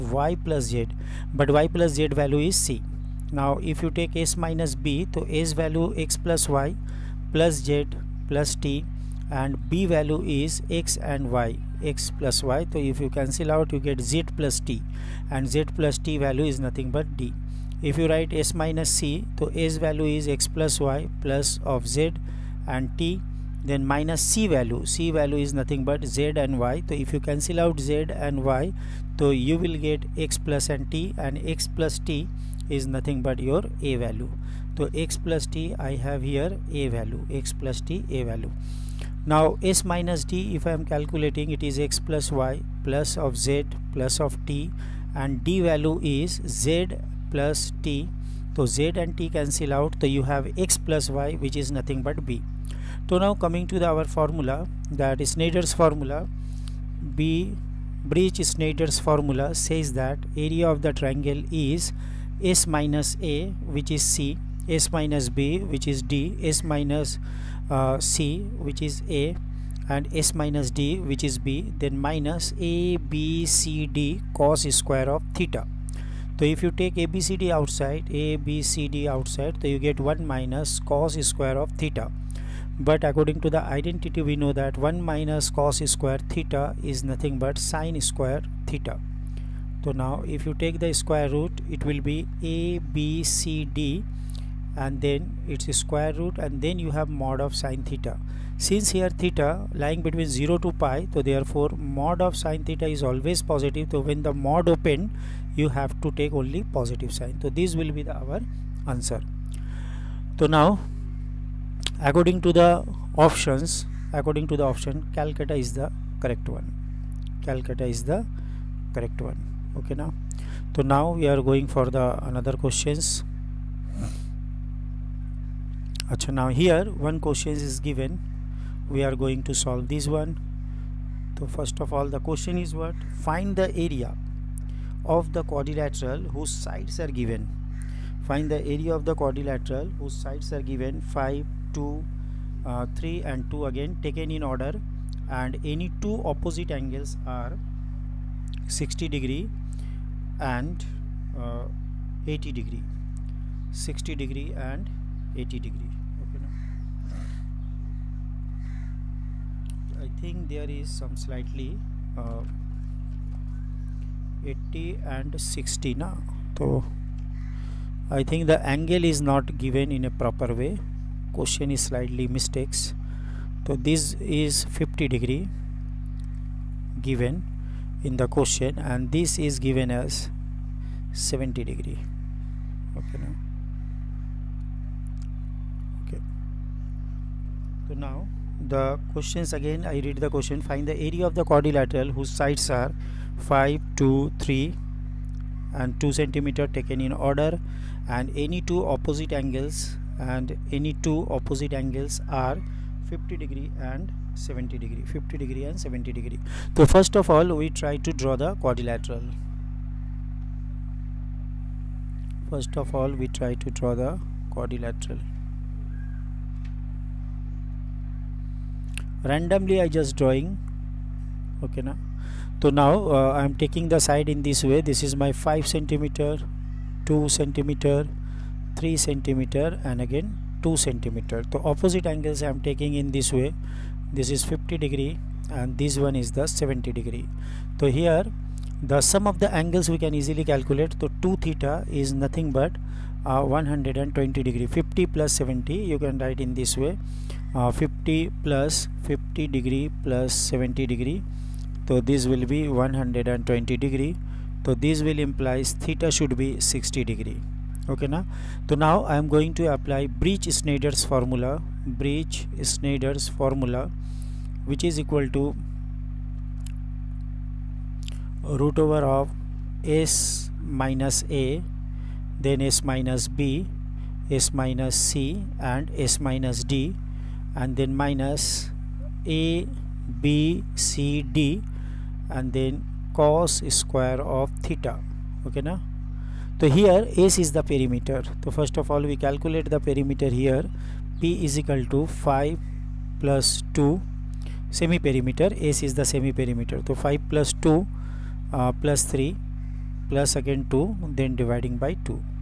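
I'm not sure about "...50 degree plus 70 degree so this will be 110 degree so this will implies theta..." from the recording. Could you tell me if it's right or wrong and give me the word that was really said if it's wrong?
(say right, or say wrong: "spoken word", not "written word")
wrong: "120", not "110".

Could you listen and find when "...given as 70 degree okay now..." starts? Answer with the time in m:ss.
2:59.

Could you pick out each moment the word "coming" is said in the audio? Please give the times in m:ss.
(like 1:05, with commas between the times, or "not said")
0:53.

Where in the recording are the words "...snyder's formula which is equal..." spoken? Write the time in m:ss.
4:22.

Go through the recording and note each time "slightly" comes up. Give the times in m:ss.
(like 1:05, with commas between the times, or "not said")
2:41, 2:51.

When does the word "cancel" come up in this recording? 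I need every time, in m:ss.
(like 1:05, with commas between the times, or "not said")
0:13, 0:27, 0:49.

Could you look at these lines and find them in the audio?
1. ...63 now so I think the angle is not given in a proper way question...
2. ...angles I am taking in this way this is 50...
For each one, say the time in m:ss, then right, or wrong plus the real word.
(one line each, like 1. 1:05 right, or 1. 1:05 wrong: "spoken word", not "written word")
1. 2:45 wrong: "60", not "63"
2. 3:52 right.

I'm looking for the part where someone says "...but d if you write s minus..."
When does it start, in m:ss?
0:16.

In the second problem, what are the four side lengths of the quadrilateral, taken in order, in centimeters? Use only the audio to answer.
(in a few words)
5, 2, 3 and 2.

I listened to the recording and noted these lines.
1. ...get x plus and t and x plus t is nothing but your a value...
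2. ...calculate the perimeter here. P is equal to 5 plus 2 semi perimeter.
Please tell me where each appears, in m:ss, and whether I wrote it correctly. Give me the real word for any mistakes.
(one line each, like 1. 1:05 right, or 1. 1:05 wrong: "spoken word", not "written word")
1. 0:29 right
2. 4:49 right.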